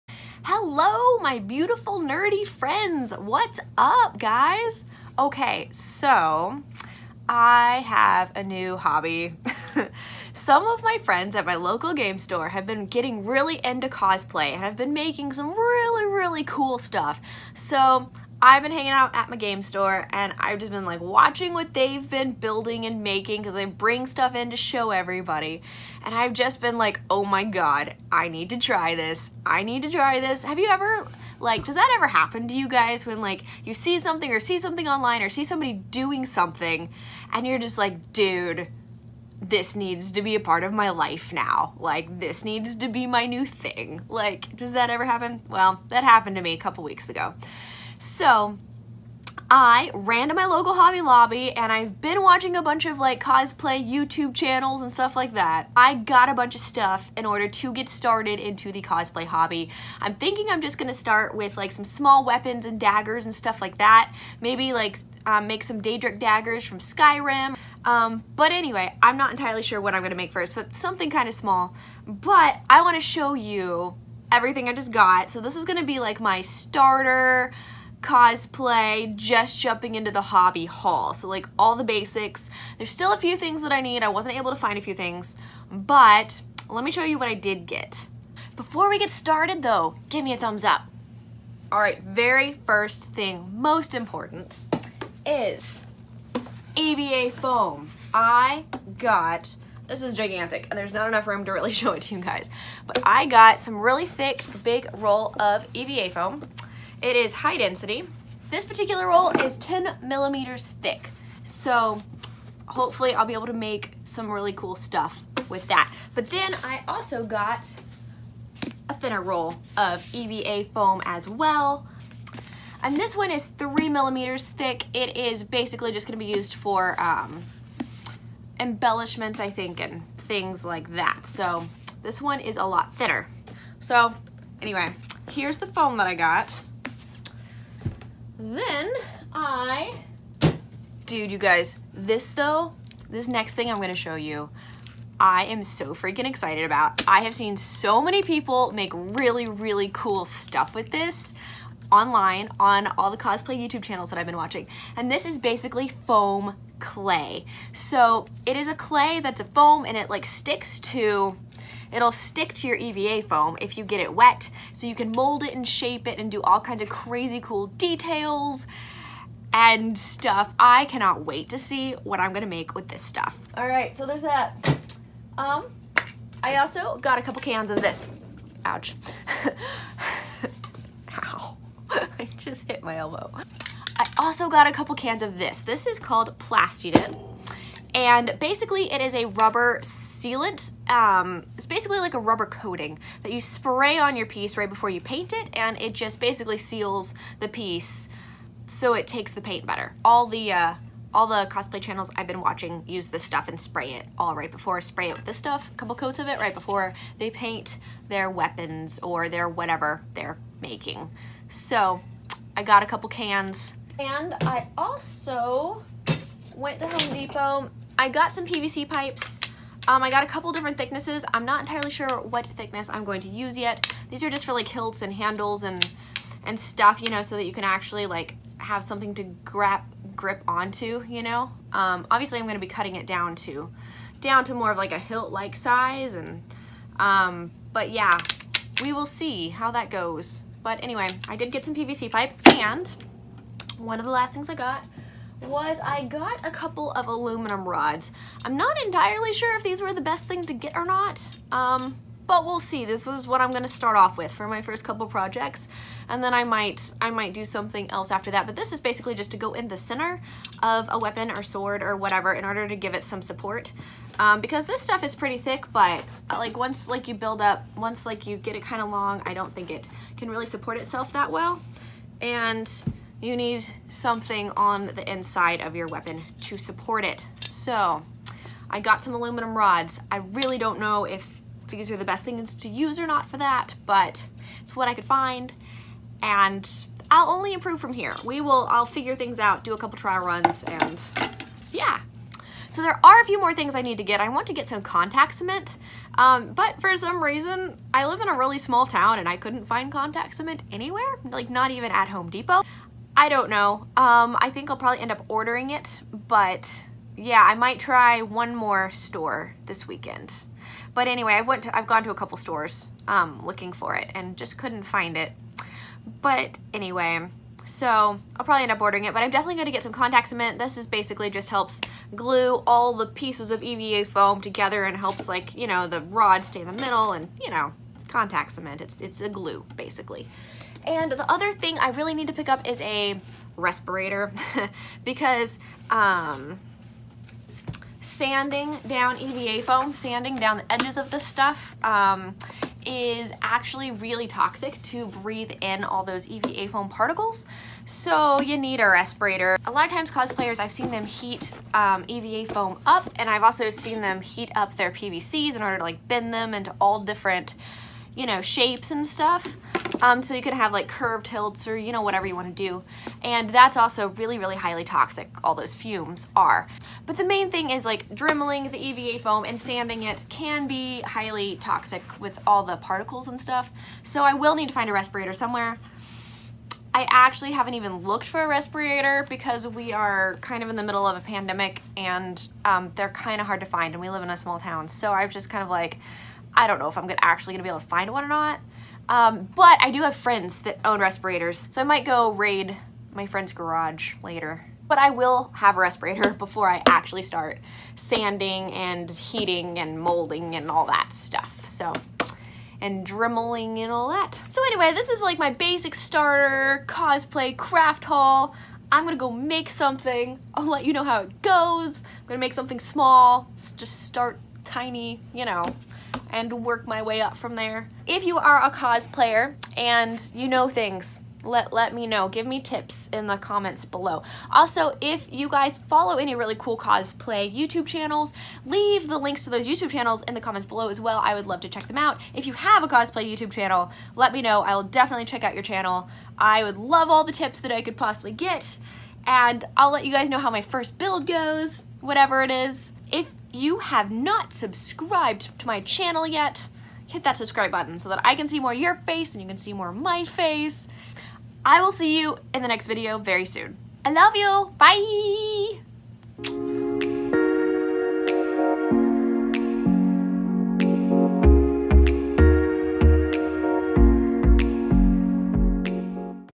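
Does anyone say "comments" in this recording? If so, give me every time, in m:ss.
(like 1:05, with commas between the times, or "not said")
7:03, 7:10.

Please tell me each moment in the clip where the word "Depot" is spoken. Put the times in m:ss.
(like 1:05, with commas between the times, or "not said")
3:37, 5:02.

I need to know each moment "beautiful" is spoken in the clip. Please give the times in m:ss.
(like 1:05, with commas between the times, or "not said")
0:01.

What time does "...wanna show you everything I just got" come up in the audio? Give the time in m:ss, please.
1:12.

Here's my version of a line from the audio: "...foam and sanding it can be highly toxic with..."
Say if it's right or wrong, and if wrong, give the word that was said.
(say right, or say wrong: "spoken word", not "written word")
right.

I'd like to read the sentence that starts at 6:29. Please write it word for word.
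Um, but I do have friends that own respirators, so I might go raid my friend's garage later.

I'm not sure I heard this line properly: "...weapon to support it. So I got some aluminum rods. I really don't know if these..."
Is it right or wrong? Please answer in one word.
right.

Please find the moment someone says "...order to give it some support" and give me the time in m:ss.
4:22.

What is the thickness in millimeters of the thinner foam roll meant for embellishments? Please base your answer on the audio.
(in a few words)
3.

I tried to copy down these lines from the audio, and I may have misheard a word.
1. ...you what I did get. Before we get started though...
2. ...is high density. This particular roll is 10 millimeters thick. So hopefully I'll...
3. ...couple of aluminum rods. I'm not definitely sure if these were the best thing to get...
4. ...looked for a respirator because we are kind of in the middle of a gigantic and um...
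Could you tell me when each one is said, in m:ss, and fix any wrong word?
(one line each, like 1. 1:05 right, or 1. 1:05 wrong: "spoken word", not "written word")
1. 1:27 right
2. 1:47 right
3. 4:06 wrong: "entirely", not "definitely"
4. 6:17 wrong: "pandemic", not "gigantic".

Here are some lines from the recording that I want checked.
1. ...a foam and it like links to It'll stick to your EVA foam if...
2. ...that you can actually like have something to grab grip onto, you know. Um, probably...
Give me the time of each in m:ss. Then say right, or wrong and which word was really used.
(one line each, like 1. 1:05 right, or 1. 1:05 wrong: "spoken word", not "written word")
1. 2:39 wrong: "sticks", not "links"
2. 3:47 wrong: "obviously", not "probably".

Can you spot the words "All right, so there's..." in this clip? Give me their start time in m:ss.
2:53.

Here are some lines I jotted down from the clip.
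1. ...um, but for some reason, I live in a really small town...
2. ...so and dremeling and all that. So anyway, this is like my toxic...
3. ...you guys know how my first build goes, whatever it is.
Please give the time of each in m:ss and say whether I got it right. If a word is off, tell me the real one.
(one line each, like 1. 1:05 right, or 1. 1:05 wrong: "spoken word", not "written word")
1. 4:56 right
2. 6:41 wrong: "basic", not "toxic"
3. 7:20 right.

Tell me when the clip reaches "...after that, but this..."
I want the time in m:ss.
4:18.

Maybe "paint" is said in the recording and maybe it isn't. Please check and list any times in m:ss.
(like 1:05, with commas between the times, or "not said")
3:15, 3:19, 3:27.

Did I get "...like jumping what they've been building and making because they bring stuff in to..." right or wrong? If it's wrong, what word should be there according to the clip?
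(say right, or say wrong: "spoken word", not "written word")
wrong: "watching", not "jumping".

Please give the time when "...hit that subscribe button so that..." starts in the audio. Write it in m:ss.
7:27.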